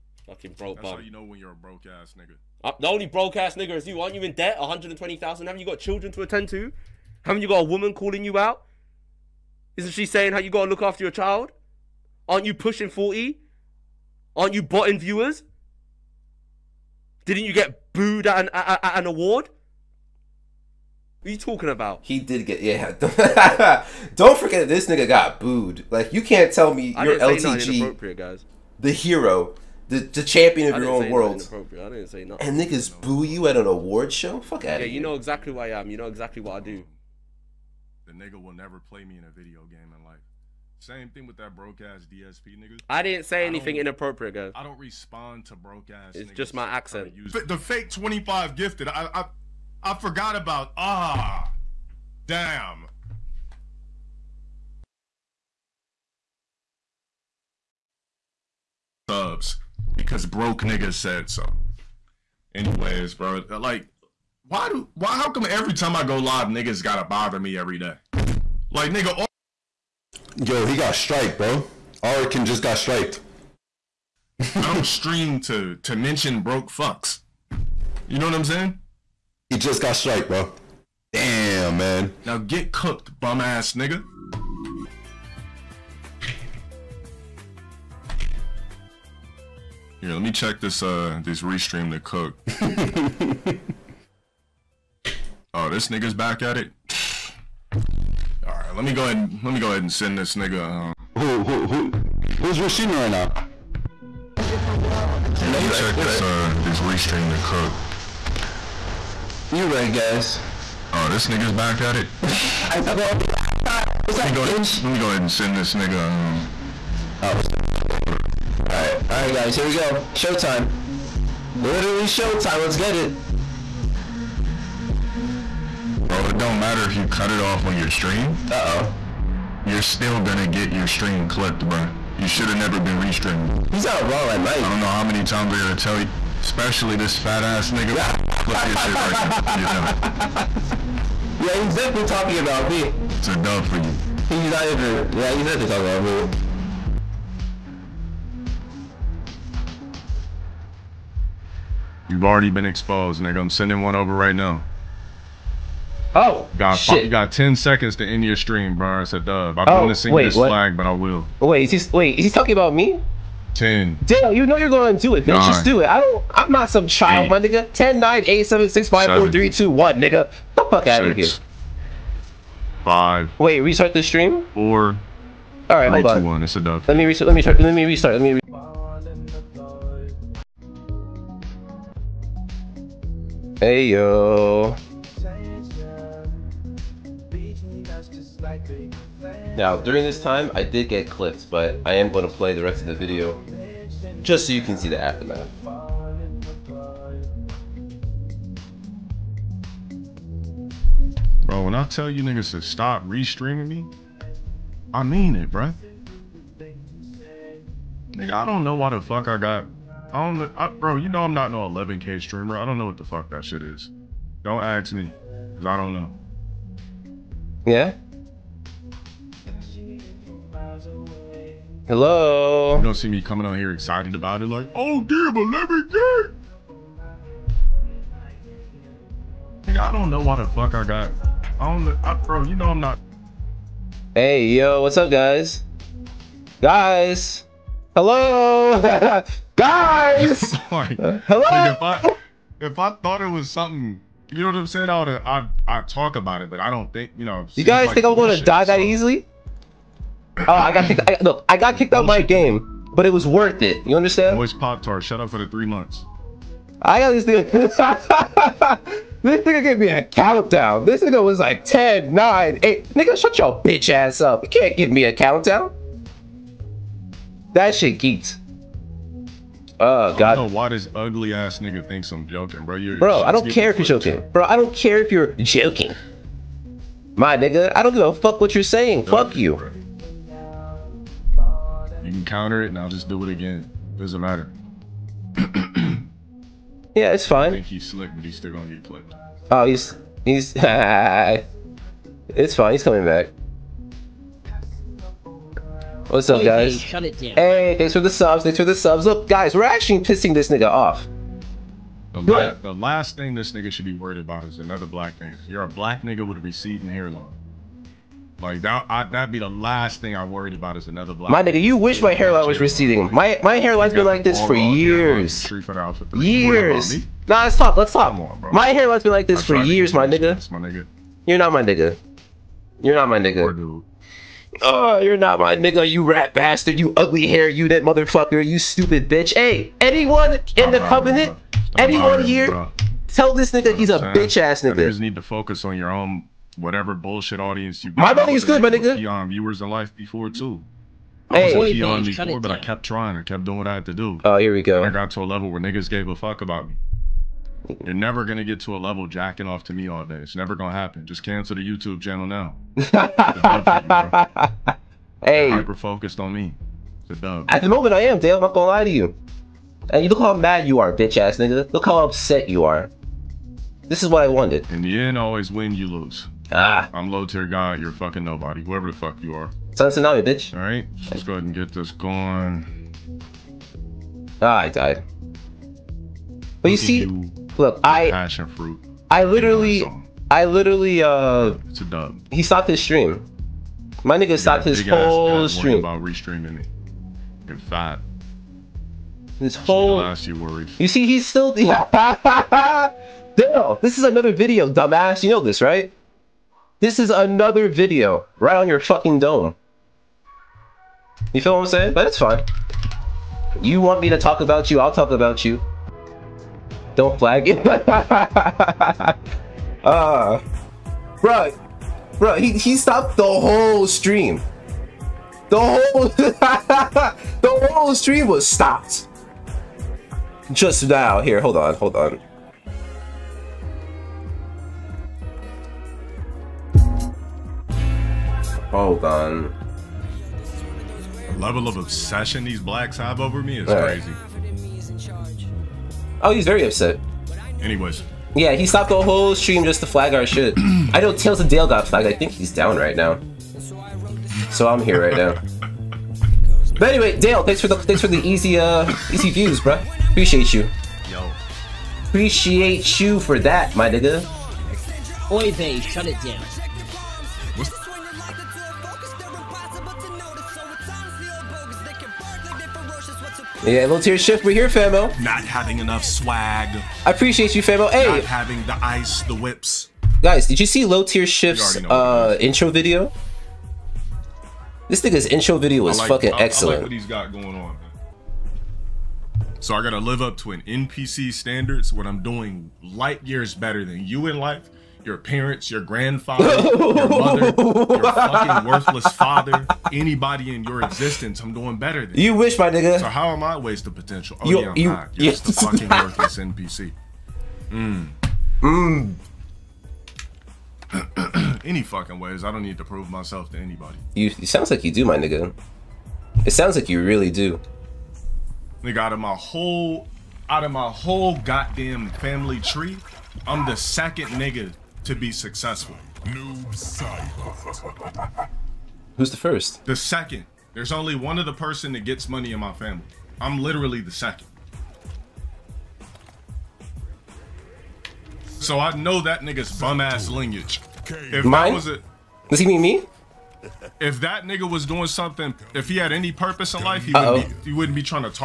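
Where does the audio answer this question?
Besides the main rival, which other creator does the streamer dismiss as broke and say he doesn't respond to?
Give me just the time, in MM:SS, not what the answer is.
00:42.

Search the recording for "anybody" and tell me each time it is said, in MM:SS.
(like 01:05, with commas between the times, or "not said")
08:09, 08:23.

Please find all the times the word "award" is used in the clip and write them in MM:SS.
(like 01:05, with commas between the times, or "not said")
00:19, 00:33.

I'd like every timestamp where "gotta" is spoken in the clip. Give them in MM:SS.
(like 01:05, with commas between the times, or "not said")
00:10, 01:06, 02:15, 07:59.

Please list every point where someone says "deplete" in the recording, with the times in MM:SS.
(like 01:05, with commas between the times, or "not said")
not said.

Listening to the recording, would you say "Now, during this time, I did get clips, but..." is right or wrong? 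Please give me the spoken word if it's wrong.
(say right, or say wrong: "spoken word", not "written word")
right.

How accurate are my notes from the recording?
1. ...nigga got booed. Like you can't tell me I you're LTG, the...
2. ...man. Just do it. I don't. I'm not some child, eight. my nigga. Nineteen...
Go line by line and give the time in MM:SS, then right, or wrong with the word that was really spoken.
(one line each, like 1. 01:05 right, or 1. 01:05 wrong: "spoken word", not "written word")
1. 00:24 right
2. 02:45 wrong: "Ten", not "Nineteen".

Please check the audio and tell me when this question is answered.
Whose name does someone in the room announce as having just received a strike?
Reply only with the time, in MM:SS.
01:12.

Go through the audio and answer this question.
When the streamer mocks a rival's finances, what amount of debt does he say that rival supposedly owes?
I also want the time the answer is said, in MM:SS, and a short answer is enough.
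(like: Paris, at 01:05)
120,000, at 00:04.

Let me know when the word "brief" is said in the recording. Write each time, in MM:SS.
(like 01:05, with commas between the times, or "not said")
not said.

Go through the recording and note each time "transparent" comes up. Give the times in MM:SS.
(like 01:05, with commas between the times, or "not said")
not said.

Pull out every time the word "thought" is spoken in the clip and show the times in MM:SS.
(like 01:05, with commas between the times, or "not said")
01:52, 04:03.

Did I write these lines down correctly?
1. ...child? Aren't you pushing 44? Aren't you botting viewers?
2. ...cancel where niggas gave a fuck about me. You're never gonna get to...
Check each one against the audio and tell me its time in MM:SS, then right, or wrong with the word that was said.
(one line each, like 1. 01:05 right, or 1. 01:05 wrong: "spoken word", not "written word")
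1. 00:11 wrong: "40", not "44"
2. 05:45 wrong: "level", not "cancel".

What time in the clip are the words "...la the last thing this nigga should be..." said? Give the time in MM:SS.
05:02.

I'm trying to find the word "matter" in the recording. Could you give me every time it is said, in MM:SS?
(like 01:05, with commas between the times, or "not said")
02:06, 04:44.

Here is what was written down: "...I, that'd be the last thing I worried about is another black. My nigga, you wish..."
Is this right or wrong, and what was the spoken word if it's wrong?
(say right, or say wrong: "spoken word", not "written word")
right.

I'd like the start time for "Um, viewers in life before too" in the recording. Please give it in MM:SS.
05:39.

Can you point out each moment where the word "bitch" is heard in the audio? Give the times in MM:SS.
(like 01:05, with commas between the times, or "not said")
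01:54, 04:23, 05:29, 05:34, 06:00, 06:10.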